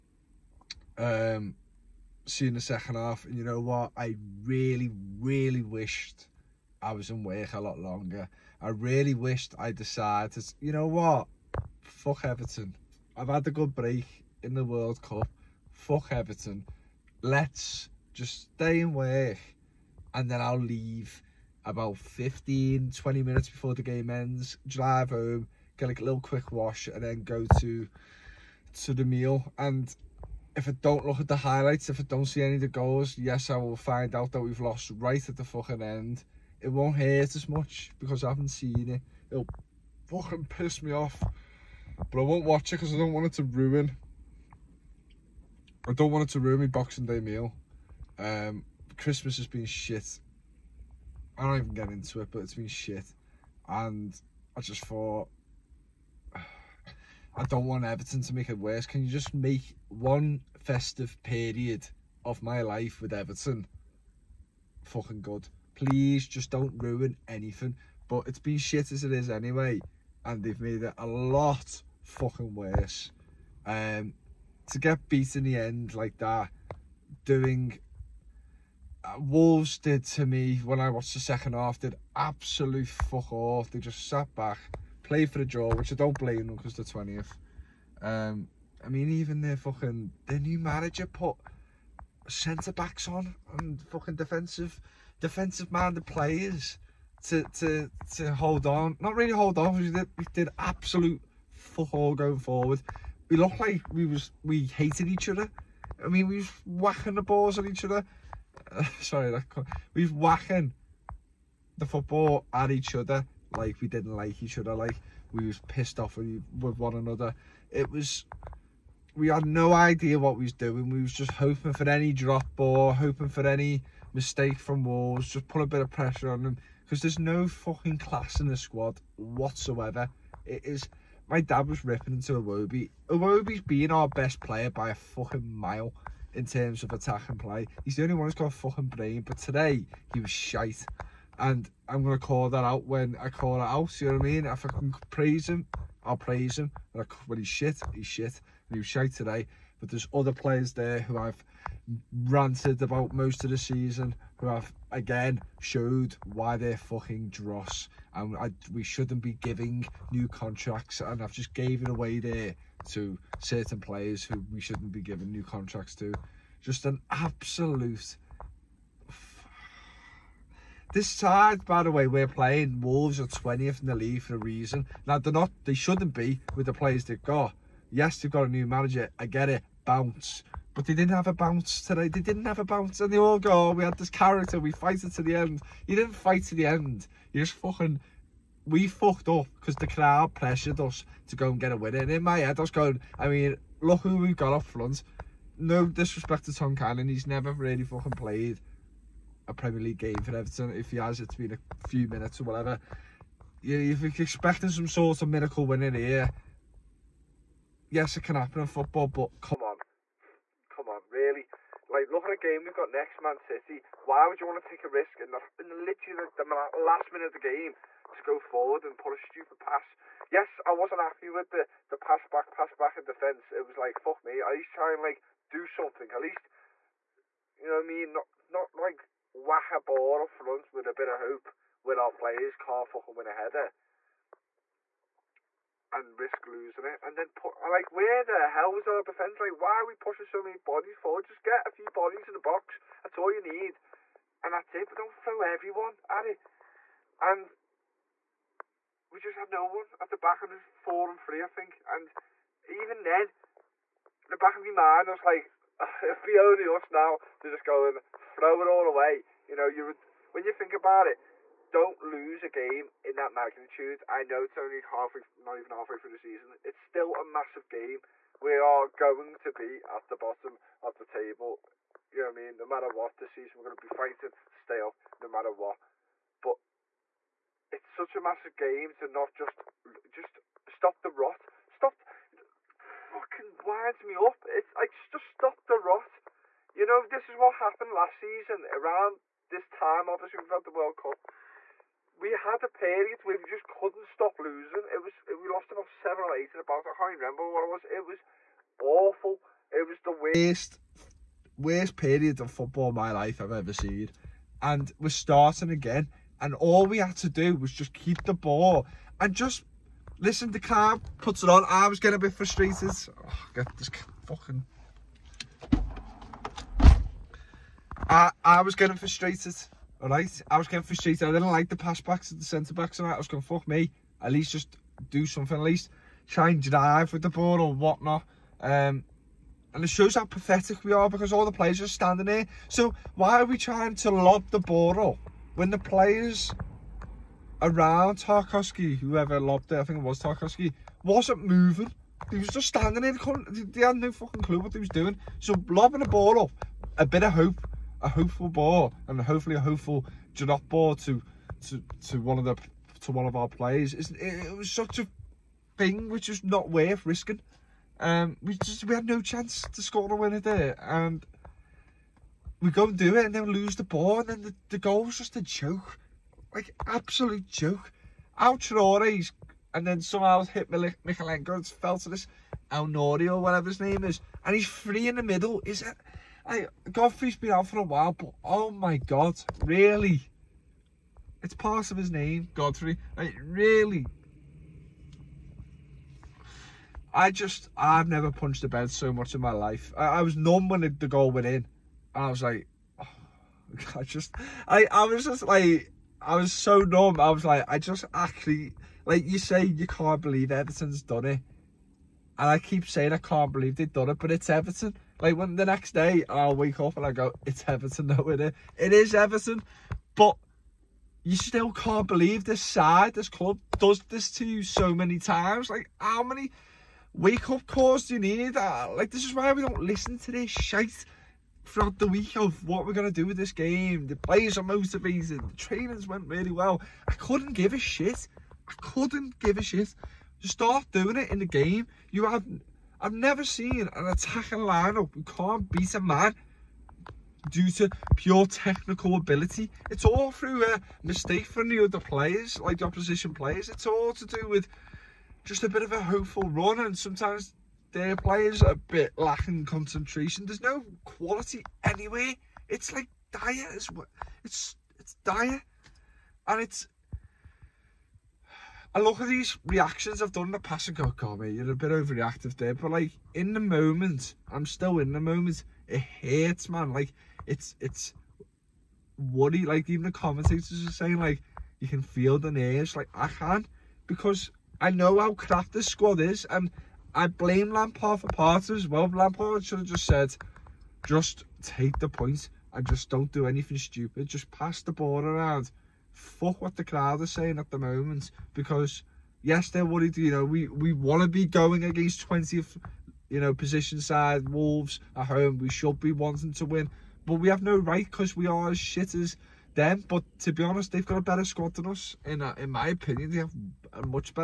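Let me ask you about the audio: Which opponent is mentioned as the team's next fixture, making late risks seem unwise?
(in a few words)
Man City.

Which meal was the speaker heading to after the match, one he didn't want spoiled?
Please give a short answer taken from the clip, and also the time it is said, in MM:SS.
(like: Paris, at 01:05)
Boxing Day meal, at 00:46.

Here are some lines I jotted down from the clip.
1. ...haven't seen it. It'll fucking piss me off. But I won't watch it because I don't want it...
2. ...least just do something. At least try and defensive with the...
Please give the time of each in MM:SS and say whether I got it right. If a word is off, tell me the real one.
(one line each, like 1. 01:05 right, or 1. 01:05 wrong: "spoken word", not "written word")
1. 00:38 right
2. 05:24 wrong: "drive", not "defensive".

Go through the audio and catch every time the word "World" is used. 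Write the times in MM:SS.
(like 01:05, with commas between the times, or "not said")
00:14, 04:50.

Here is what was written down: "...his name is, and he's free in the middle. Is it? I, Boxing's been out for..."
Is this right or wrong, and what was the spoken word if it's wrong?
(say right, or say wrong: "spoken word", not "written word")
wrong: "Godfrey", not "Boxing".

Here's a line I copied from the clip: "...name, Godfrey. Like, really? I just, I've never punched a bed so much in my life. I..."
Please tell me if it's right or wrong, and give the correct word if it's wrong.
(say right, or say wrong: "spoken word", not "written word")
right.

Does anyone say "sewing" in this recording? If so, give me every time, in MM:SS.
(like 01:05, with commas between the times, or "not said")
not said.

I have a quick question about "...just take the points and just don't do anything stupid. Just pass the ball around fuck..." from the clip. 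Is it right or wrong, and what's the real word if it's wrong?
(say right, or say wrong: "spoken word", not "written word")
right.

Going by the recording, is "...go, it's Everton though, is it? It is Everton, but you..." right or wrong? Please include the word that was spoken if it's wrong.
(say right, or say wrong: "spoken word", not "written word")
right.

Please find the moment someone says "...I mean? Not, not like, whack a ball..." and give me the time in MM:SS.
03:47.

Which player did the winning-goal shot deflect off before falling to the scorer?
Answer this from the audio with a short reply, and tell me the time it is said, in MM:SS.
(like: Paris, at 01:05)
Mykolenko, at 06:10.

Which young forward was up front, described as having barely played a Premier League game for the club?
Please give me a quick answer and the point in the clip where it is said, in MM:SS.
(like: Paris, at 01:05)
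Tom Cannon, at 03:15.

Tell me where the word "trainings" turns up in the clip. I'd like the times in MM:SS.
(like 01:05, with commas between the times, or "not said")
07:05.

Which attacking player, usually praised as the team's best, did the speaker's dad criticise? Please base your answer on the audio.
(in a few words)
Iwobi.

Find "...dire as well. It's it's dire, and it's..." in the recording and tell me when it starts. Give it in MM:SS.
07:33.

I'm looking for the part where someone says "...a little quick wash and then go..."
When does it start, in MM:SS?
00:25.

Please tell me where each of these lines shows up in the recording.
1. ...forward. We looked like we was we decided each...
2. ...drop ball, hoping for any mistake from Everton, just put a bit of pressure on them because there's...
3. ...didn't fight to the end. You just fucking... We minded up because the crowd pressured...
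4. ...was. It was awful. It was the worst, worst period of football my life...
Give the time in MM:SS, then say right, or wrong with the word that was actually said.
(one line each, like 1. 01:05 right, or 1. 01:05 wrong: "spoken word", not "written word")
1. 01:42 wrong: "hated", not "decided"
2. 02:02 wrong: "Wolves", not "Everton"
3. 03:05 wrong: "fucked", not "minded"
4. 04:57 right.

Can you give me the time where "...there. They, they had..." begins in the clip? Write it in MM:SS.
05:43.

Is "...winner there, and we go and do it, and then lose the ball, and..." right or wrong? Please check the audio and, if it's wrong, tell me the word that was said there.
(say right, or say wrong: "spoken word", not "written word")
right.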